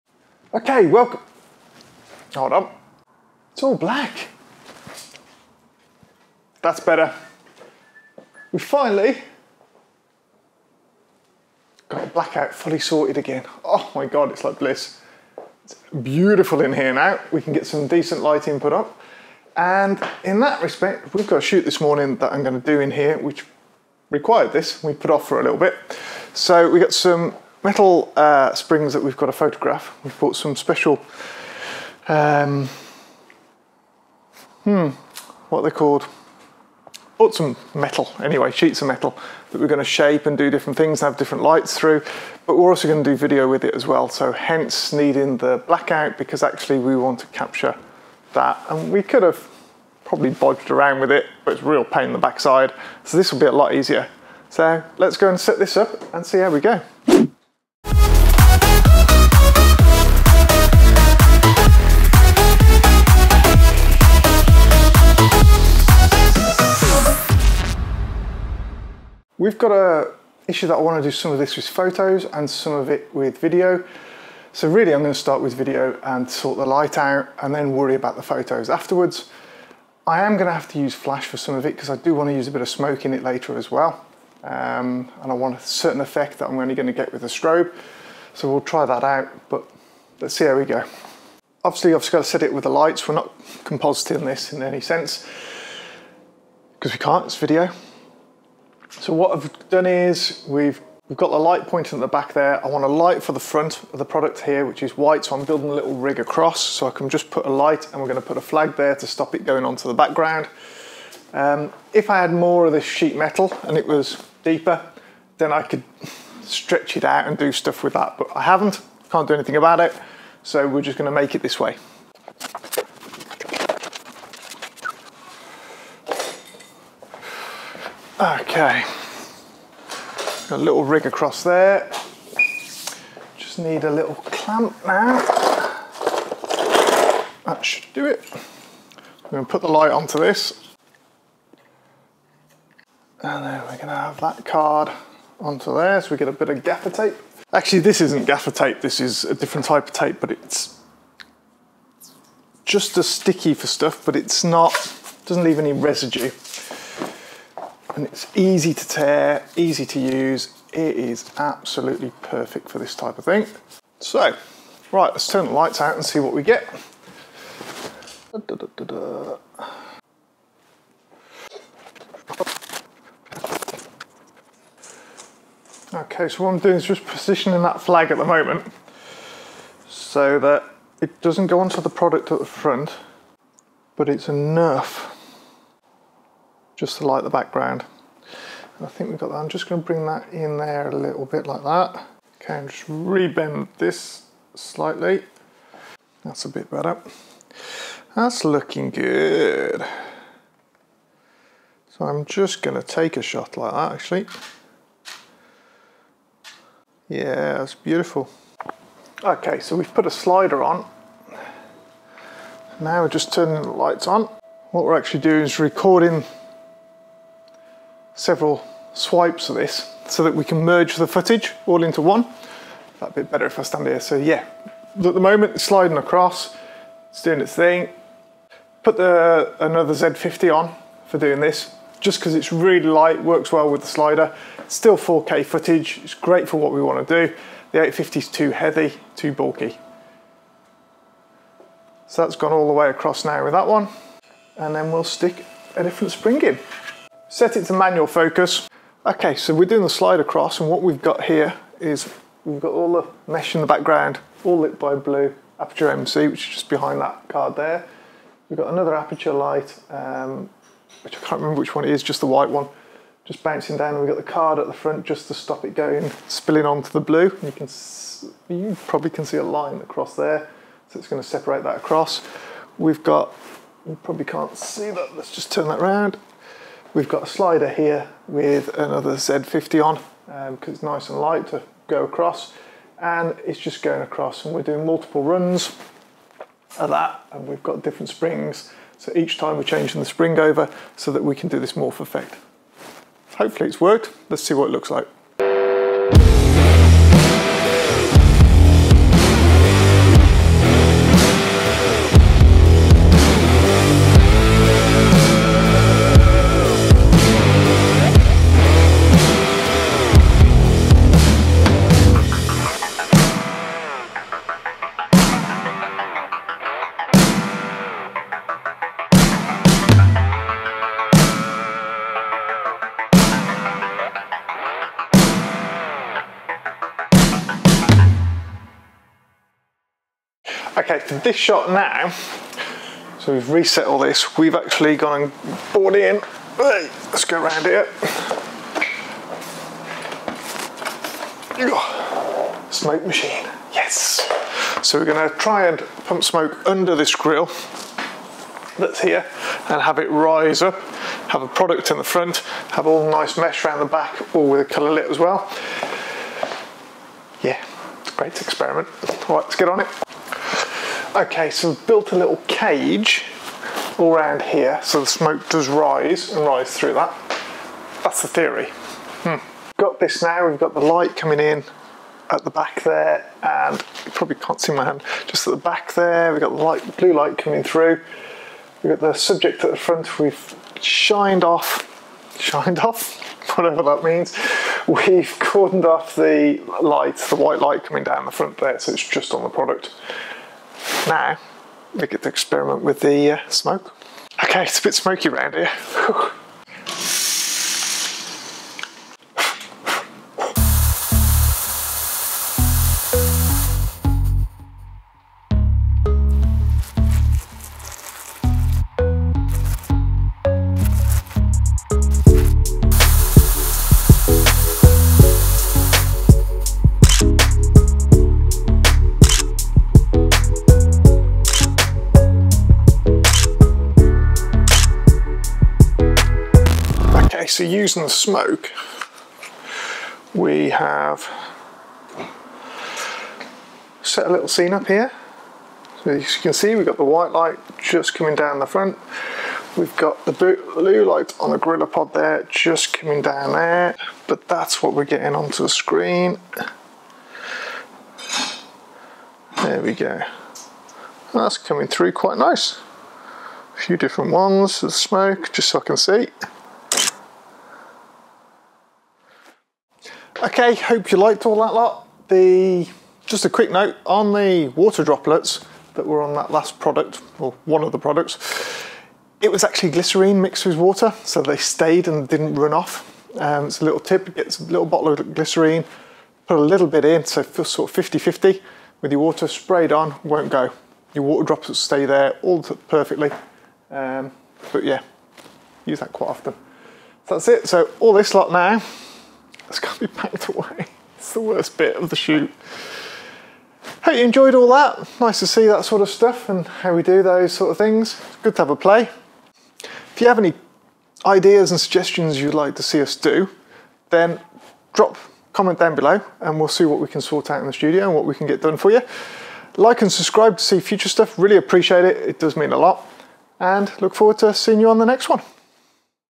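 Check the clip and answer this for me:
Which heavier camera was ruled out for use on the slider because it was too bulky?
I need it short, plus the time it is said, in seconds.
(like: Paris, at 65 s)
850, at 237 s.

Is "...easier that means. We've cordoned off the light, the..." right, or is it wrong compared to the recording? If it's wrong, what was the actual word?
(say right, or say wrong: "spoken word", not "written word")
wrong: "whatever", not "easier".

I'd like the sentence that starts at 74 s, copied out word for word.
So really I'm going to start with video and sort the light out and then worry about the photos afterwards.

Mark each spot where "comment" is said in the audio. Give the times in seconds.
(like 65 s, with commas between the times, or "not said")
505 s.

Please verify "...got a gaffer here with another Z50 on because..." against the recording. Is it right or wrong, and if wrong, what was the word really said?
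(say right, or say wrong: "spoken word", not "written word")
wrong: "slider", not "gaffer".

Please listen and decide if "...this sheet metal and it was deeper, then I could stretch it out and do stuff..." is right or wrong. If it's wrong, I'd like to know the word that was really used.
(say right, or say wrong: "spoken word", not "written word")
right.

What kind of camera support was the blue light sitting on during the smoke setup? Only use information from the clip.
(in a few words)
GorillaPod.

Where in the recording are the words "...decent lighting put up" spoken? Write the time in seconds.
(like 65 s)
17 s.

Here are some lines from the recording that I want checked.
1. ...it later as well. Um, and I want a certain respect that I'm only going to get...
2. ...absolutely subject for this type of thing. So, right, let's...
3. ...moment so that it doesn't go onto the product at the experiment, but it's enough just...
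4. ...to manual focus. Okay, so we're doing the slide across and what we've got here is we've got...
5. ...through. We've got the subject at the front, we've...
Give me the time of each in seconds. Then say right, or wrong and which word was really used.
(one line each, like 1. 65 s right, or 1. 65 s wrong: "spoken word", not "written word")
1. 83 s wrong: "effect", not "respect"
2. 161 s wrong: "perfect", not "subject"
3. 178 s wrong: "front", not "experiment"
4. 247 s right
5. 377 s right.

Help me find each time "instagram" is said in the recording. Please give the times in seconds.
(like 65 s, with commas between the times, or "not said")
not said.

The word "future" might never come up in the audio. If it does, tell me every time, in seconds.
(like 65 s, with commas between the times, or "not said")
510 s.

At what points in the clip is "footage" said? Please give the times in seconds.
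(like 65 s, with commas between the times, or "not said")
221 s, 235 s.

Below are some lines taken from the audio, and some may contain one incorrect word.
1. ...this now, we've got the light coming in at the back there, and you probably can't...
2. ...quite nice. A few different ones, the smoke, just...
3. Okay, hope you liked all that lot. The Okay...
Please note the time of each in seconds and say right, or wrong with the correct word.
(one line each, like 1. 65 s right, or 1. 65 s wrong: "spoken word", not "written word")
1. 369 s right
2. 452 s right
3. 460 s wrong: "Just", not "Okay".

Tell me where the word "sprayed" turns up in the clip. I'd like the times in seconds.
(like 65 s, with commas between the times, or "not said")
479 s.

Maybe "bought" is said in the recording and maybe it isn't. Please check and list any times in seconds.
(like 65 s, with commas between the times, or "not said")
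30 s, 37 s, 335 s.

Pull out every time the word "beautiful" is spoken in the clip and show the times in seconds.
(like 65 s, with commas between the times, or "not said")
16 s, 207 s.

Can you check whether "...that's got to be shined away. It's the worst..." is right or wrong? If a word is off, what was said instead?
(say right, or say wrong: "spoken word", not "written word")
wrong: "packed", not "shined".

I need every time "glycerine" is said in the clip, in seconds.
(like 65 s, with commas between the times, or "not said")
469 s, 475 s.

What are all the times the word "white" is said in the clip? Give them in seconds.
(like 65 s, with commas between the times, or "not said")
104 s, 262 s, 387 s, 437 s.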